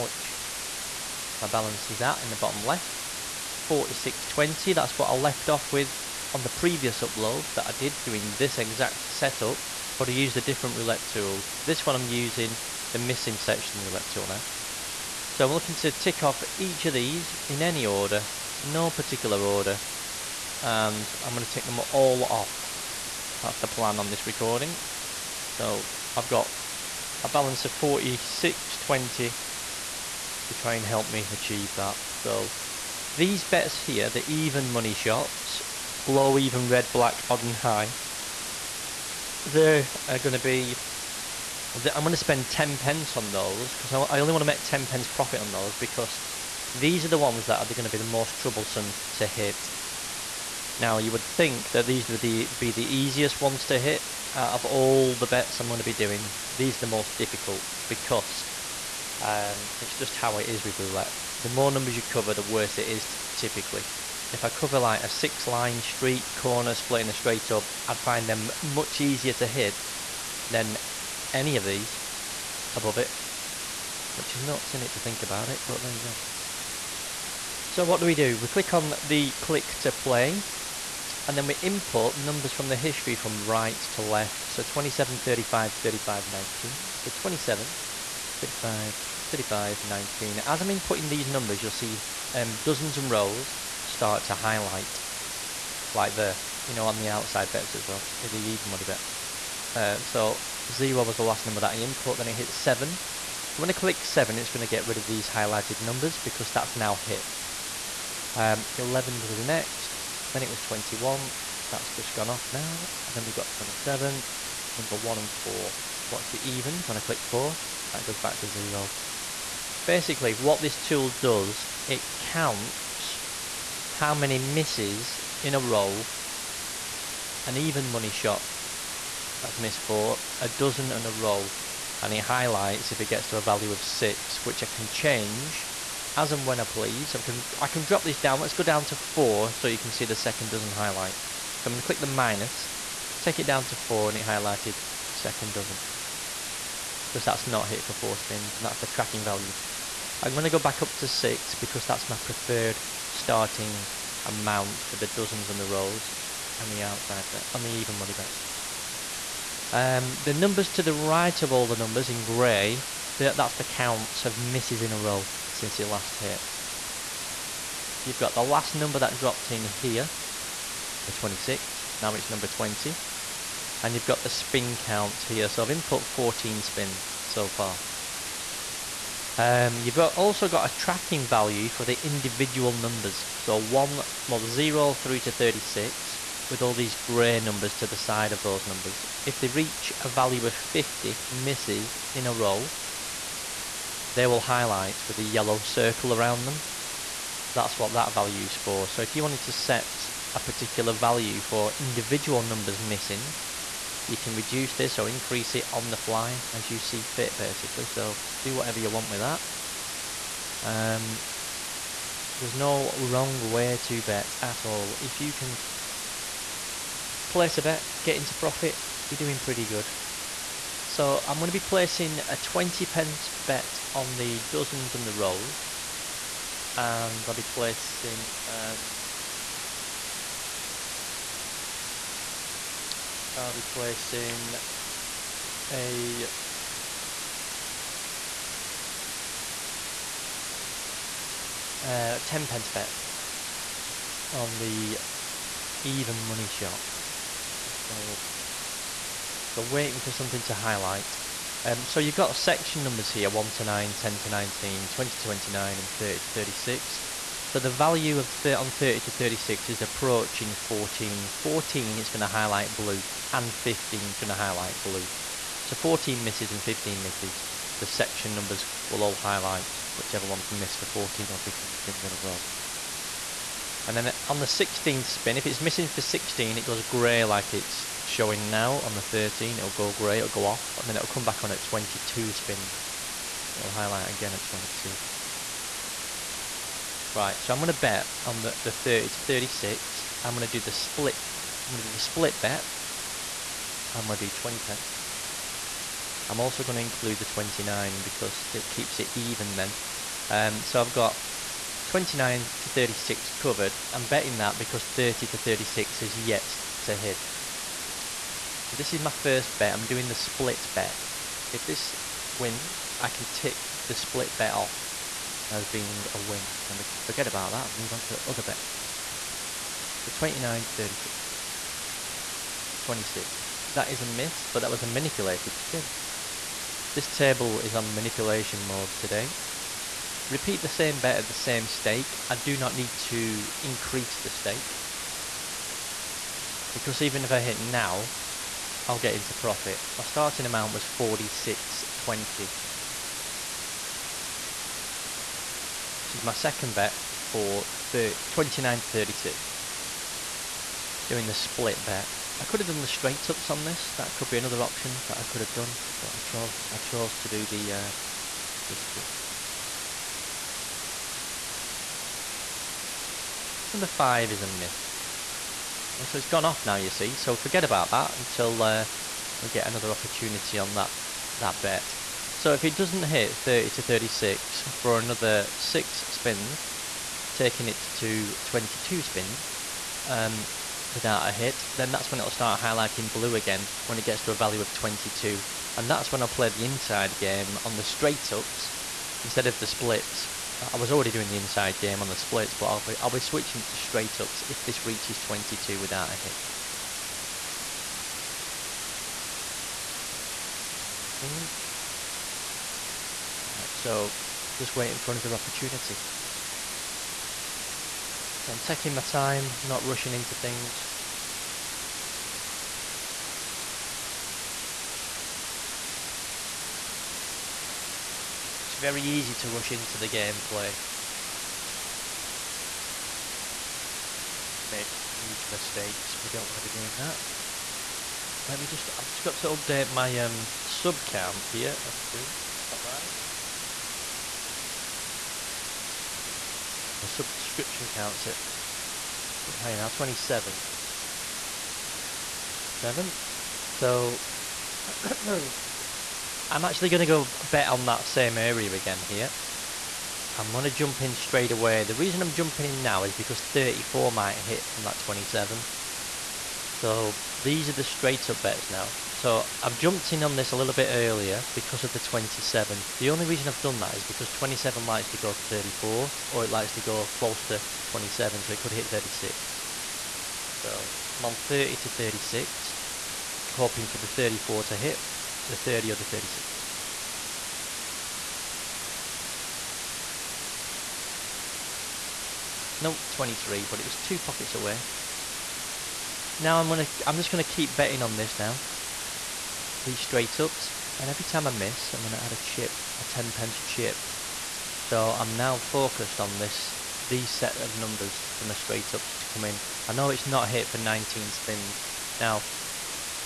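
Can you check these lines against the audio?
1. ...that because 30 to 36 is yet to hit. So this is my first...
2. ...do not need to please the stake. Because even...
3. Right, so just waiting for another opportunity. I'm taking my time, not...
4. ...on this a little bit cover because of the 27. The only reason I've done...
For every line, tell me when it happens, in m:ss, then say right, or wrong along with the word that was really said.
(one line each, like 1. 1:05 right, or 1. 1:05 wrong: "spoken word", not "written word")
1. 5:04 right
2. 5:32 wrong: "increase", not "please"
3. 6:43 right
4. 7:40 wrong: "earlier", not "cover".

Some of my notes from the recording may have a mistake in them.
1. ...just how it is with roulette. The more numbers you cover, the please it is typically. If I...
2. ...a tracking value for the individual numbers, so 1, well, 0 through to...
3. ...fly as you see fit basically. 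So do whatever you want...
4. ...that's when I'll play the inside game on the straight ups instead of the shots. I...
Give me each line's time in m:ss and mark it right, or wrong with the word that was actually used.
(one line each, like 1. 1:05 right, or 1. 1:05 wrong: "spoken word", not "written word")
1. 0:59 wrong: "worse", not "please"
2. 3:00 right
3. 3:25 right
4. 6:25 wrong: "splits", not "shots".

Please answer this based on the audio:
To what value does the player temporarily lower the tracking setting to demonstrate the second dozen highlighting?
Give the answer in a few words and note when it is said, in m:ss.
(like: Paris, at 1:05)
4, at 2:18.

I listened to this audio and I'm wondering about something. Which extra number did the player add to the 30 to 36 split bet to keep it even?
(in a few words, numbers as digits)
29.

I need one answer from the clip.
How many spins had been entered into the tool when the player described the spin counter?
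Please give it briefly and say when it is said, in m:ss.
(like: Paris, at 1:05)
14, at 2:55.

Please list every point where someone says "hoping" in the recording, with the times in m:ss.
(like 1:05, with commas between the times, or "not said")
7:53.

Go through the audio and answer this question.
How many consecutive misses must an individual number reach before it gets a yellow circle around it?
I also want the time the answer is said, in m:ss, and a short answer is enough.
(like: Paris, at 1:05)
50, at 3:10.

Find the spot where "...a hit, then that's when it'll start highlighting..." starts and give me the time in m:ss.
6:21.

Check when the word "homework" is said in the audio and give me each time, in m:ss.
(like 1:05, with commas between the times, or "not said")
not said.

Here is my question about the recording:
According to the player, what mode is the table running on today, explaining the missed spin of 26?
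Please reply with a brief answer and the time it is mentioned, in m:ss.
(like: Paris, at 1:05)
manipulation mode, at 5:27.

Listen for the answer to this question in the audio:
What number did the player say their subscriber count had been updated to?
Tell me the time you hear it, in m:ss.
7:19.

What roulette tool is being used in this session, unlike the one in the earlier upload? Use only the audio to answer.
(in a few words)
missing section roulette tool.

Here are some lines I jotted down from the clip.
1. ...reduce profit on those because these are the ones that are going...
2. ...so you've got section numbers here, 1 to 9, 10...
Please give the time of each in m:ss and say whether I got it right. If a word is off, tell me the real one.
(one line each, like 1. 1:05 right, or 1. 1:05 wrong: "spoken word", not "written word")
1. 0:44 wrong: "pence", not "reduce"
2. 4:11 right.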